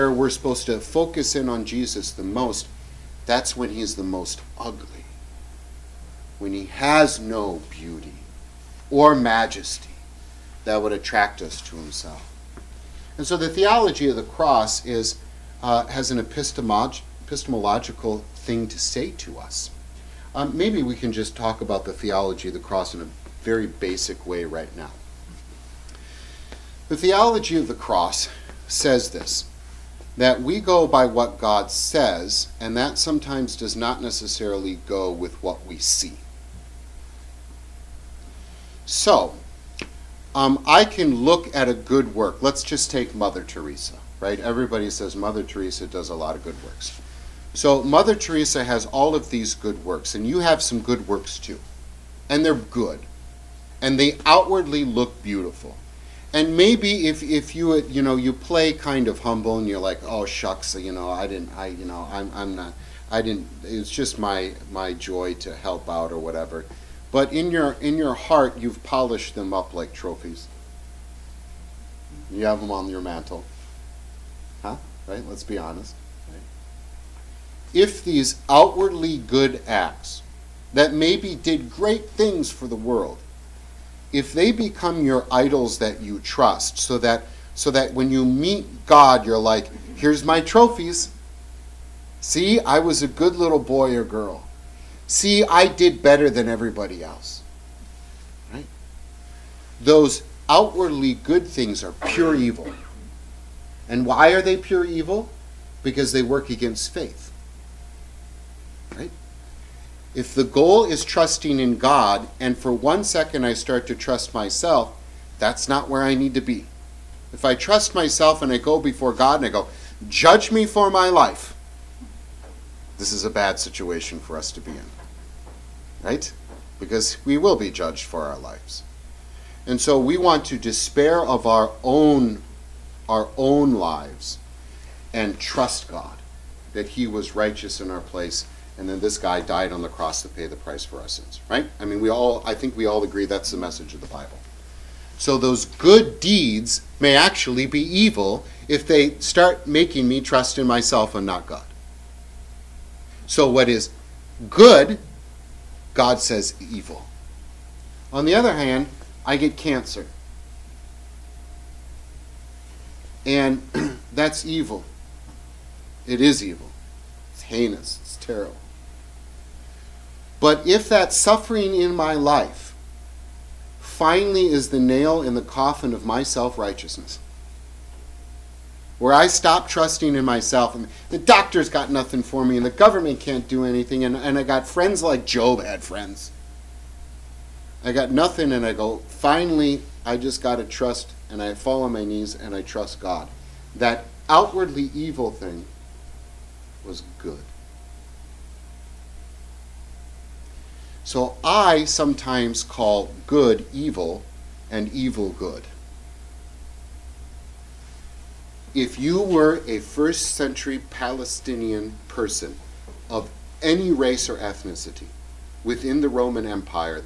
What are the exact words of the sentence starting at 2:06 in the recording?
Because we will be judged for our lives.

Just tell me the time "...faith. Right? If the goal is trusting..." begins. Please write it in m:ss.
1:46.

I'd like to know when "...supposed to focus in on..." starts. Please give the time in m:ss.
0:00.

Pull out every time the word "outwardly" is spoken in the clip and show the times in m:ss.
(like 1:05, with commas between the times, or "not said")
0:54, 1:18, 1:40, 3:14.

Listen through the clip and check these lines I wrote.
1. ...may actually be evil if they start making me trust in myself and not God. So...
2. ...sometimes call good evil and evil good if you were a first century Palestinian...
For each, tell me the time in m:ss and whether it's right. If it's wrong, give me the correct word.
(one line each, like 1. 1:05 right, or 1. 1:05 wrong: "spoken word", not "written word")
1. 2:26 right
2. 3:21 right.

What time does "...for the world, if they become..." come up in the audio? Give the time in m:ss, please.
1:22.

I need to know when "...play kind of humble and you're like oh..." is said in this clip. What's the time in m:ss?
0:58.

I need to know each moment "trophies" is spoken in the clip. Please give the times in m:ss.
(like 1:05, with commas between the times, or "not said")
1:09, 1:30.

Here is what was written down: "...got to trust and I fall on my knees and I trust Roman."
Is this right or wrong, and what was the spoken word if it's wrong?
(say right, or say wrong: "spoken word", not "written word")
wrong: "God", not "Roman".